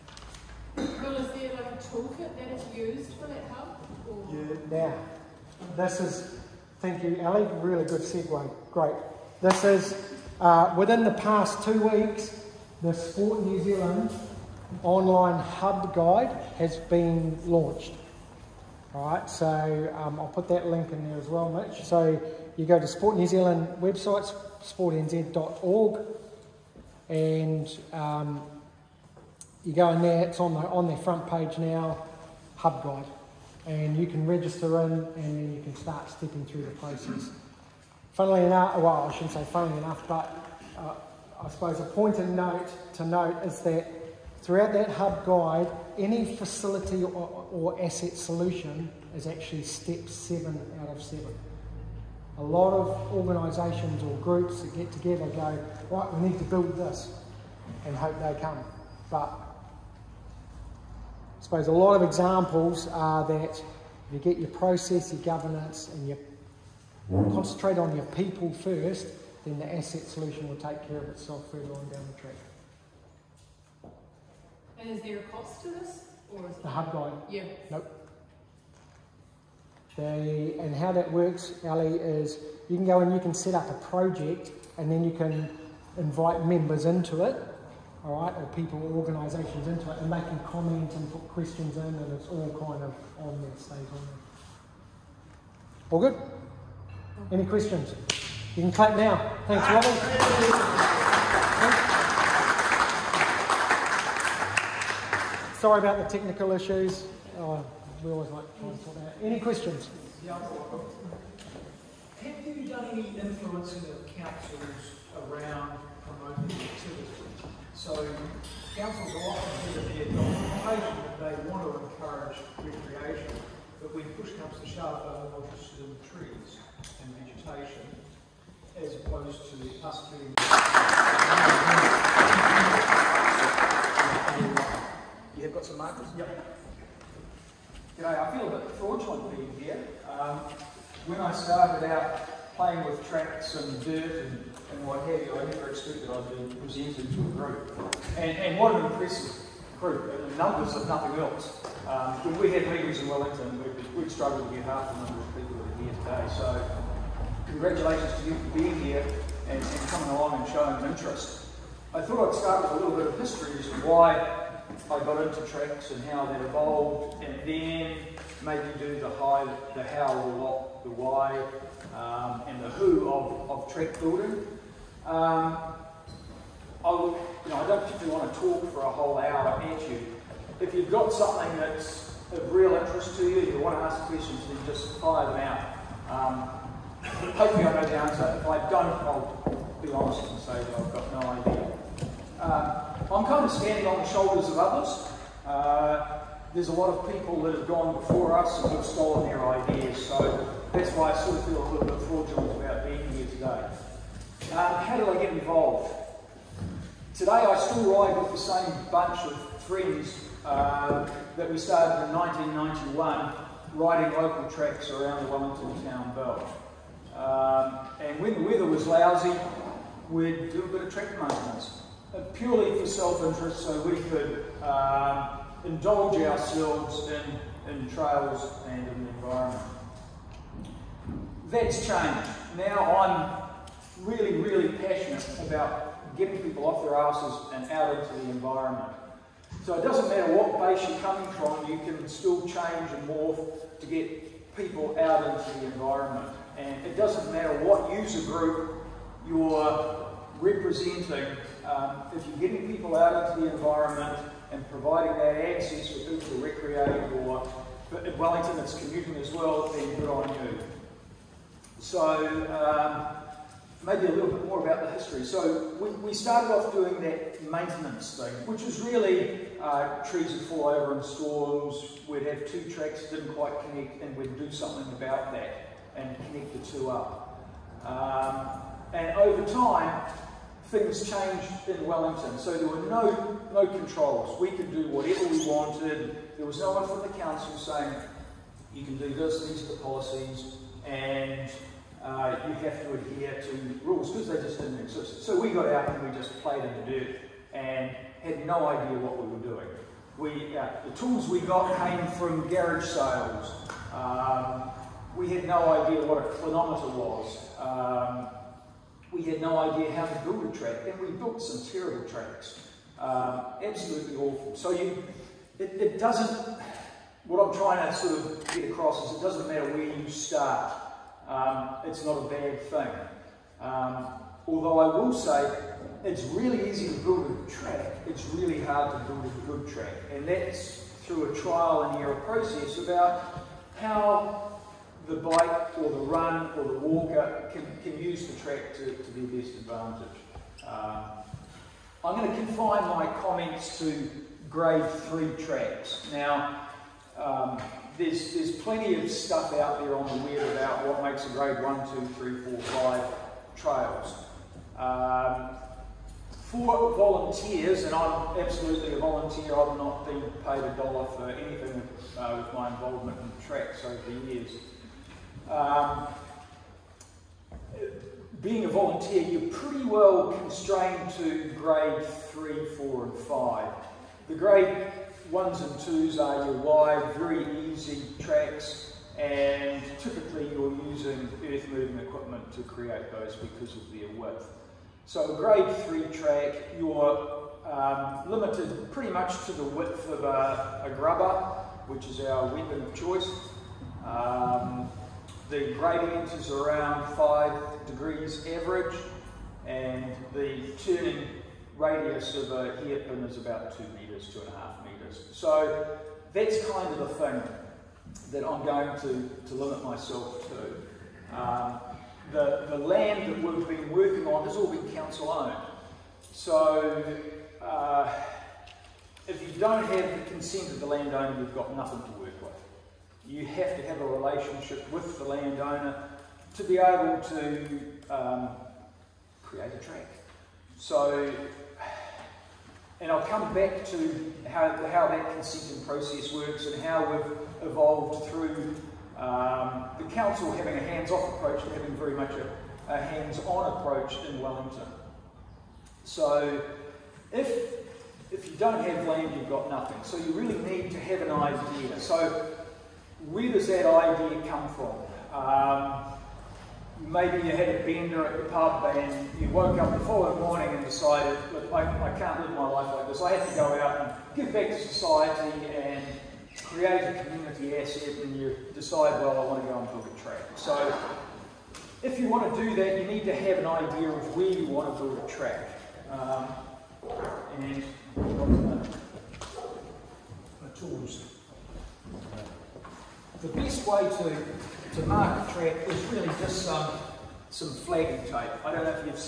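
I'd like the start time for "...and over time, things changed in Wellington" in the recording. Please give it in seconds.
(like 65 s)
278 s.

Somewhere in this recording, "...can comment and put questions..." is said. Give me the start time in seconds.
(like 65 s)
90 s.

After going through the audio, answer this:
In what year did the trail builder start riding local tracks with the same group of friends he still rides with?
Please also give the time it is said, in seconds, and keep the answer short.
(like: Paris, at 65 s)
1991, at 212 s.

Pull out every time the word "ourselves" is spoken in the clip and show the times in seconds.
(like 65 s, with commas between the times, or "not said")
226 s.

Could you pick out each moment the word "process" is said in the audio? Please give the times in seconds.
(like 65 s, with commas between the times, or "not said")
36 s, 64 s, 332 s, 435 s.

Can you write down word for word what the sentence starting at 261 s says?
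So um, maybe a little bit more about the history.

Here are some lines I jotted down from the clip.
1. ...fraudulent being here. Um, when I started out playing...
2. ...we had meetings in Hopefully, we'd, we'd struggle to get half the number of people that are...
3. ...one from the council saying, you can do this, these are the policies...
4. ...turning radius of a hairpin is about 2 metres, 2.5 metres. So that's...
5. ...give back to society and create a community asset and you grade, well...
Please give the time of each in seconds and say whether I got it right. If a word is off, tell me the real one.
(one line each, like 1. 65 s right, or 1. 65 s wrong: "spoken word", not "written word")
1. 138 s right
2. 152 s wrong: "Wellington", not "Hopefully"
3. 286 s right
4. 400 s right
5. 464 s wrong: "decide", not "grade".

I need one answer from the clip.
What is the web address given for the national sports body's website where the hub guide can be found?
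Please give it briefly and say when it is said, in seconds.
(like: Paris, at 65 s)
sportnz.org, at 24 s.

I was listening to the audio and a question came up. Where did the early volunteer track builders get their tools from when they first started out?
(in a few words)
Garage sales.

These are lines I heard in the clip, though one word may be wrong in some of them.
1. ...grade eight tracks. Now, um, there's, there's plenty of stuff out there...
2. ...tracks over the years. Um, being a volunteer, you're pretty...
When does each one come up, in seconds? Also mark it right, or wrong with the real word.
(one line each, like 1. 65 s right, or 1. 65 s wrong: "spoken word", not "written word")
1. 344 s wrong: "three", not "eight"
2. 363 s right.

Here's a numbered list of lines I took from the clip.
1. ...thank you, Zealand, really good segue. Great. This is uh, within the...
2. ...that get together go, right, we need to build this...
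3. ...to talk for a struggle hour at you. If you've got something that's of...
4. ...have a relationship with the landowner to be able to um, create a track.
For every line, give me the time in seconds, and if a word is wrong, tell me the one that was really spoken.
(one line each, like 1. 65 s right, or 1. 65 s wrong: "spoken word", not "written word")
1. 6 s wrong: "Ali", not "Zealand"
2. 54 s right
3. 178 s wrong: "whole", not "struggle"
4. 423 s right.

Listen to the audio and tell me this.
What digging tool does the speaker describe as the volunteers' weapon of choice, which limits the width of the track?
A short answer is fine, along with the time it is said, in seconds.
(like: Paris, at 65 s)
Grubber, at 390 s.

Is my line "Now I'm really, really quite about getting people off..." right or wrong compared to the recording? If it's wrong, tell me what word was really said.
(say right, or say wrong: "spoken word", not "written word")
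wrong: "passionate", not "quite".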